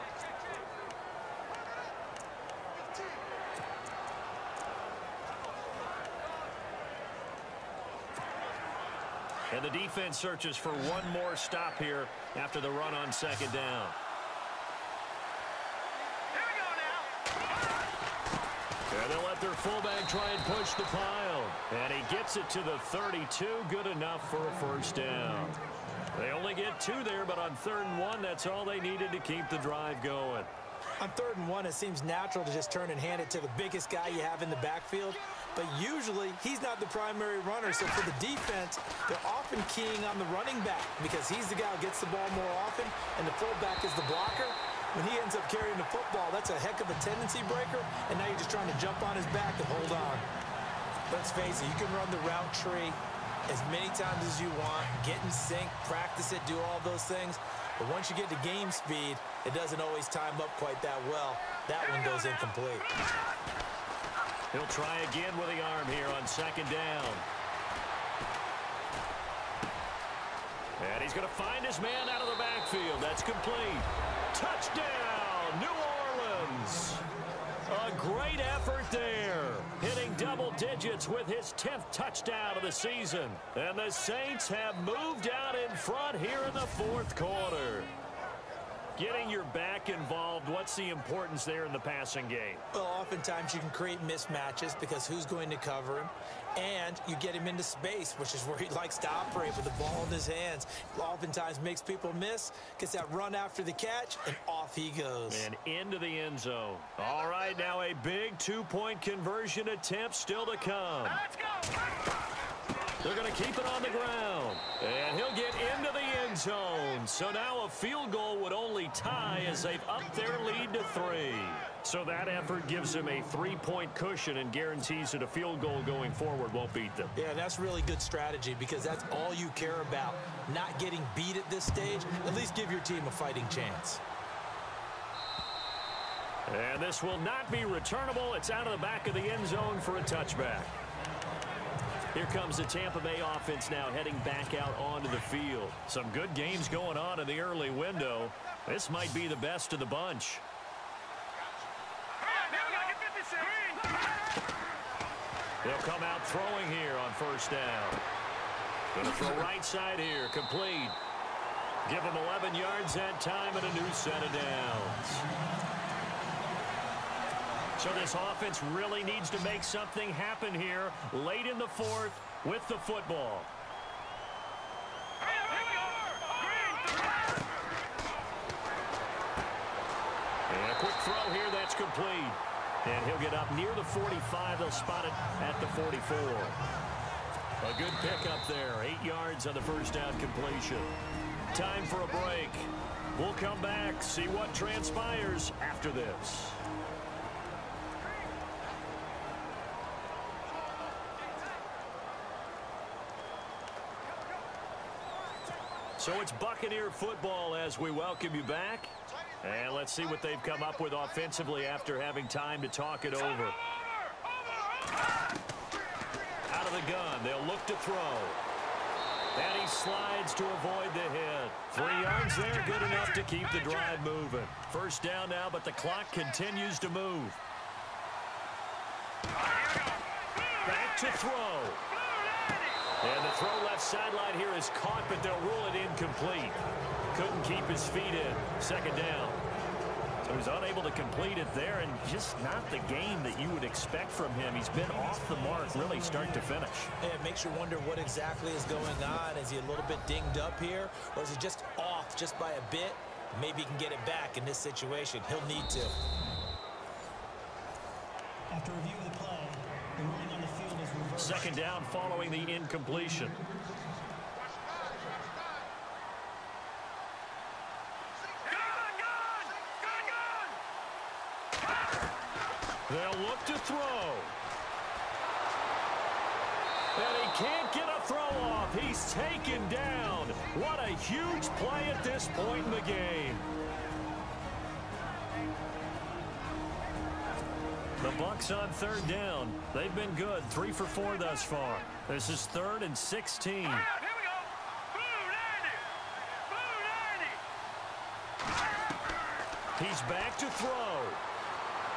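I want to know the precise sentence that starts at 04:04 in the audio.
He's been off the mark, really, start to finish.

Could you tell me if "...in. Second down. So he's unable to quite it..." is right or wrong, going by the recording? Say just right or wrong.
wrong.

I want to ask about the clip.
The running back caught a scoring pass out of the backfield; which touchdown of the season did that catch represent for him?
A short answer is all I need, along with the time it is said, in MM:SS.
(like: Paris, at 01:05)
10th, at 01:21.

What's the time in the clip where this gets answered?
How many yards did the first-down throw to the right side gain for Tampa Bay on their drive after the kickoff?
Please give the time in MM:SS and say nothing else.
02:42.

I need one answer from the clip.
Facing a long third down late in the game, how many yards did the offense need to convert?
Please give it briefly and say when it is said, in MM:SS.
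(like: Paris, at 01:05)
16, at 04:52.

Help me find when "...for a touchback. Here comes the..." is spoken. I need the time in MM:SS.
02:19.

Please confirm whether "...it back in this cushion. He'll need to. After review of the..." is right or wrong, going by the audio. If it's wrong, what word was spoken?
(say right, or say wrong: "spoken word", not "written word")
wrong: "situation", not "cushion".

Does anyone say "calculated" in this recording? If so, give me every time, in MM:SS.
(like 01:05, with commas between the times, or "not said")
not said.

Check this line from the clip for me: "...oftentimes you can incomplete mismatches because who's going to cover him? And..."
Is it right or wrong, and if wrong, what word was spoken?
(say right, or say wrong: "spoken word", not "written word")
wrong: "create", not "incomplete".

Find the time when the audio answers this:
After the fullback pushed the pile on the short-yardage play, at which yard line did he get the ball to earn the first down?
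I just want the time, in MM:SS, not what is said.
00:22.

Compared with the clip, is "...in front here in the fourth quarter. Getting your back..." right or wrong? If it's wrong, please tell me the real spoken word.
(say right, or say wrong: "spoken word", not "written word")
right.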